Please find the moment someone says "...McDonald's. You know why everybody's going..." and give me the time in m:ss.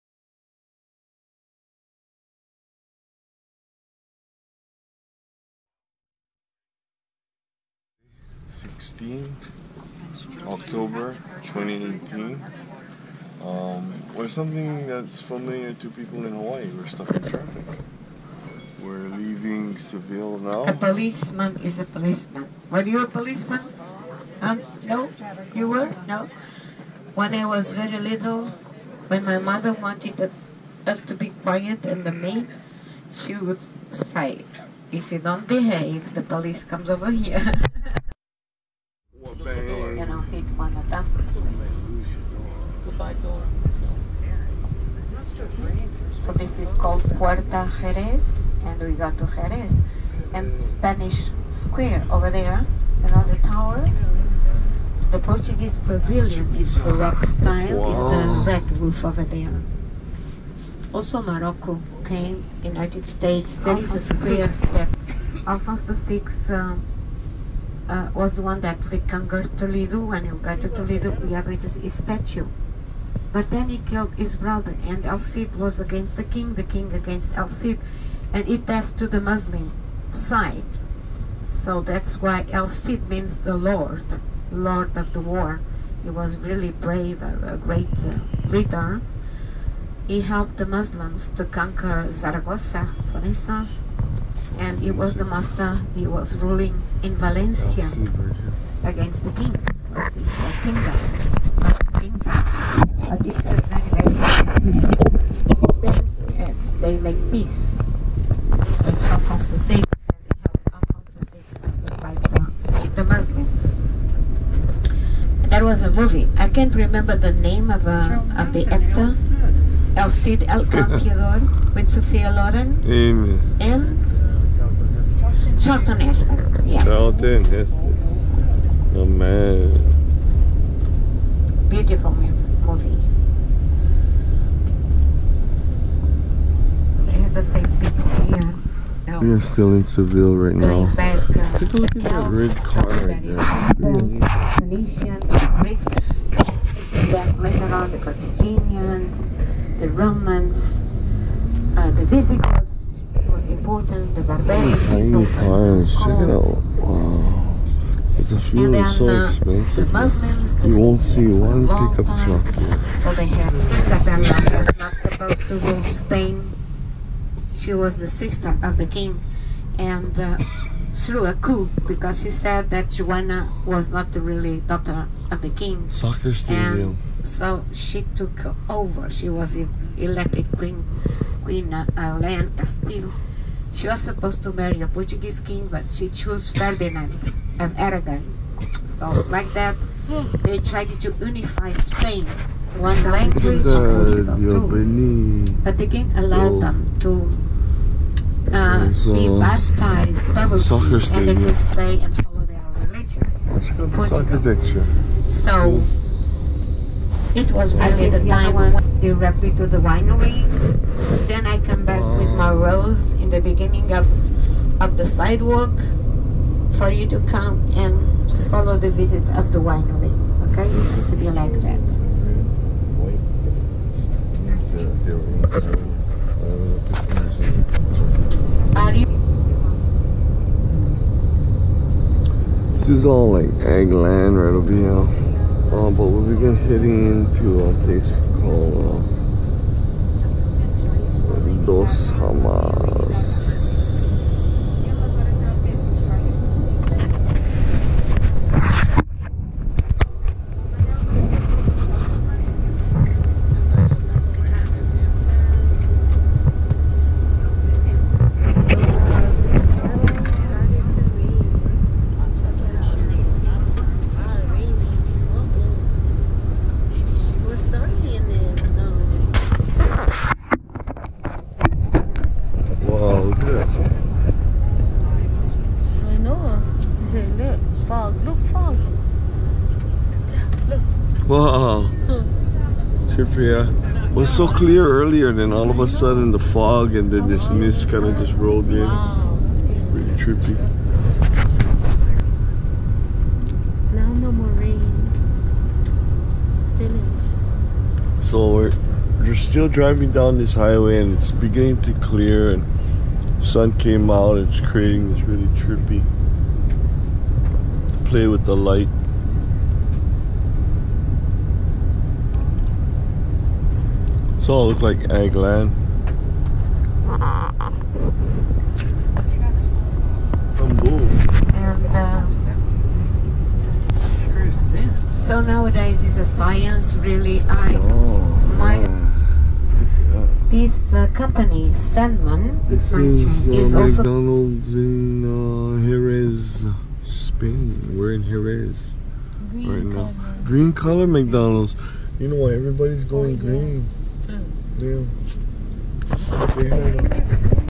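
5:41.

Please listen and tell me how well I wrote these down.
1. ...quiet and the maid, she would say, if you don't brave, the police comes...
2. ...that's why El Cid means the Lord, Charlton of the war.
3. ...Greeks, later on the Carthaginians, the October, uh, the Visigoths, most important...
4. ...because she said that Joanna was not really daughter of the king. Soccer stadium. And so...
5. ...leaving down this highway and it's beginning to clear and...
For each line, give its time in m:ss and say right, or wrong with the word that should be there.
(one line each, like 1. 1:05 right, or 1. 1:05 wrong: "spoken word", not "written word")
1. 0:31 wrong: "behave", not "brave"
2. 1:21 wrong: "Lord", not "Charlton"
3. 2:25 wrong: "Romans", not "October"
4. 2:51 right
5. 4:59 wrong: "driving", not "leaving".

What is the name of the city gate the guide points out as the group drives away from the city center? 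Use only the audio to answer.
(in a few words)
Puerta Jerez.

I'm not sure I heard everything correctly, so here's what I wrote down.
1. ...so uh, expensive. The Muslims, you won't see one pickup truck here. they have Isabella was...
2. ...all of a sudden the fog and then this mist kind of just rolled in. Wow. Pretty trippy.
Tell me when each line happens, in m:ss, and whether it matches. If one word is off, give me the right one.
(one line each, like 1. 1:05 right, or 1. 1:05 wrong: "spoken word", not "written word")
1. 2:38 right
2. 4:45 right.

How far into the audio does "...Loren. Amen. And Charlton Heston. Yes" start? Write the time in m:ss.
2:02.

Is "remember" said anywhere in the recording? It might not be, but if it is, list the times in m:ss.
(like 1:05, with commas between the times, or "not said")
1:56.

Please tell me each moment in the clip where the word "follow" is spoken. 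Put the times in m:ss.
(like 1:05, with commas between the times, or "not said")
3:22, 3:38.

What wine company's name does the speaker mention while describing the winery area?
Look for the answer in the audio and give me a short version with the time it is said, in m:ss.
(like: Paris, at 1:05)
Sandeman, at 5:31.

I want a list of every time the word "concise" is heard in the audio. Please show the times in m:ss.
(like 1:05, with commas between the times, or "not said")
not said.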